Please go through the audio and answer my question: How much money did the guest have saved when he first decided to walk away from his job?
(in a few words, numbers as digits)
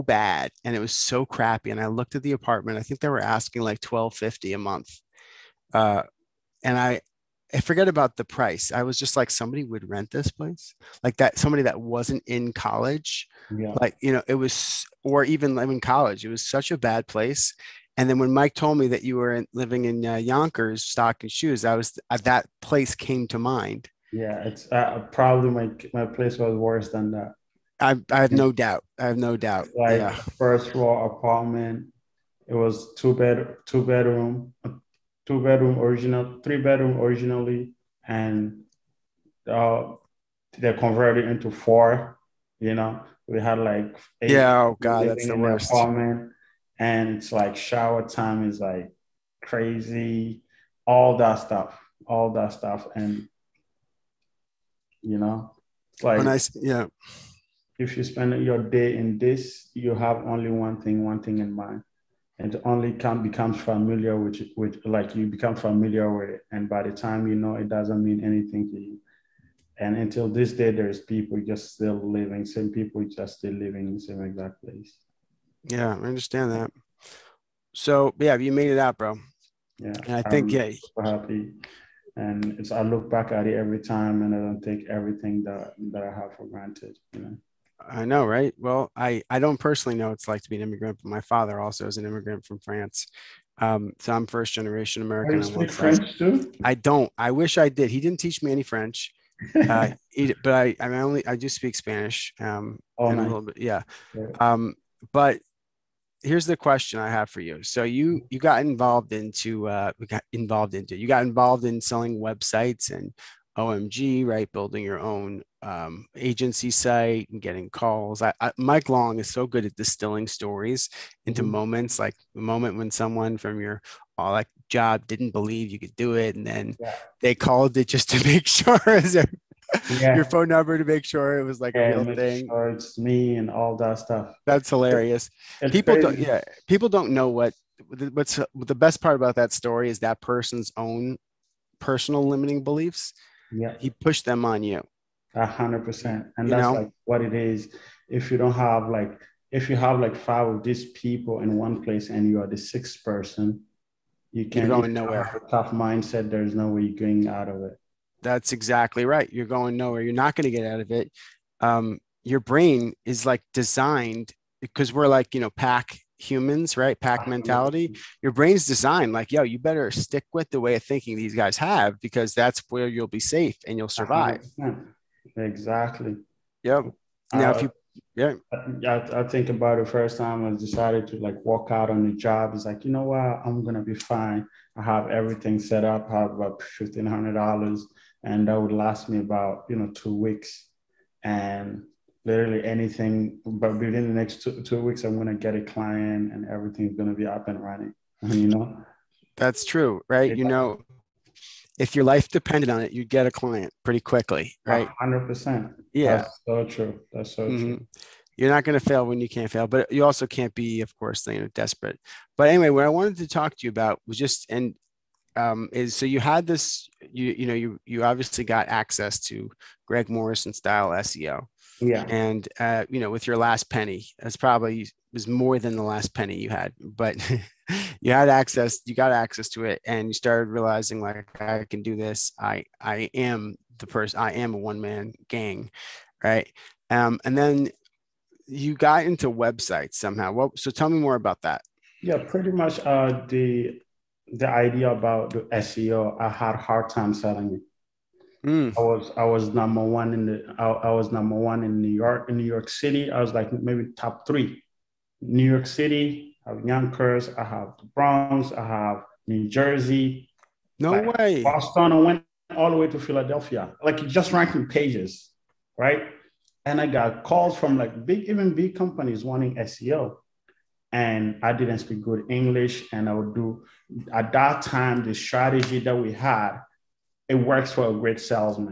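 $1,500.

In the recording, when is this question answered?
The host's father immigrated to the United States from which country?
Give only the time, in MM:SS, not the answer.
01:32.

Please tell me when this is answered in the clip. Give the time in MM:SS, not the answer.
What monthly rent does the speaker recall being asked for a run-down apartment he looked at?
00:03.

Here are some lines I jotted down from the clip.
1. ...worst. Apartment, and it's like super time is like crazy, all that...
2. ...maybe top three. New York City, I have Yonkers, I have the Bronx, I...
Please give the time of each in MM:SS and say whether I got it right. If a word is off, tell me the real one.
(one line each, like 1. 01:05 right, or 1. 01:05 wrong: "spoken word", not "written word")
1. 00:45 wrong: "shower", not "super"
2. 04:13 right.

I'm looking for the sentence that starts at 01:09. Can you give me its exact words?
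And until this day, there's people just still living, same people just still living in the same exact place.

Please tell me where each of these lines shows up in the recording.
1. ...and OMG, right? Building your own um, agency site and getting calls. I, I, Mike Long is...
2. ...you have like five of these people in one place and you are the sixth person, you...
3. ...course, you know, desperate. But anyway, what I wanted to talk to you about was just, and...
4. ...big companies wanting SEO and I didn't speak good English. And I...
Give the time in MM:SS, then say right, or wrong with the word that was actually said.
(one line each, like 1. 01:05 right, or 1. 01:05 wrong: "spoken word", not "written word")
1. 01:52 right
2. 02:29 right
3. 03:30 right
4. 04:28 right.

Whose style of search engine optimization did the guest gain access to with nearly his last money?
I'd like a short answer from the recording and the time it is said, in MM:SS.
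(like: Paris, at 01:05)
Greg Morrison, at 03:39.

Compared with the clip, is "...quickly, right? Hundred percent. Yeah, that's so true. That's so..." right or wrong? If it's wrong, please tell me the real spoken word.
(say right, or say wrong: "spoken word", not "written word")
right.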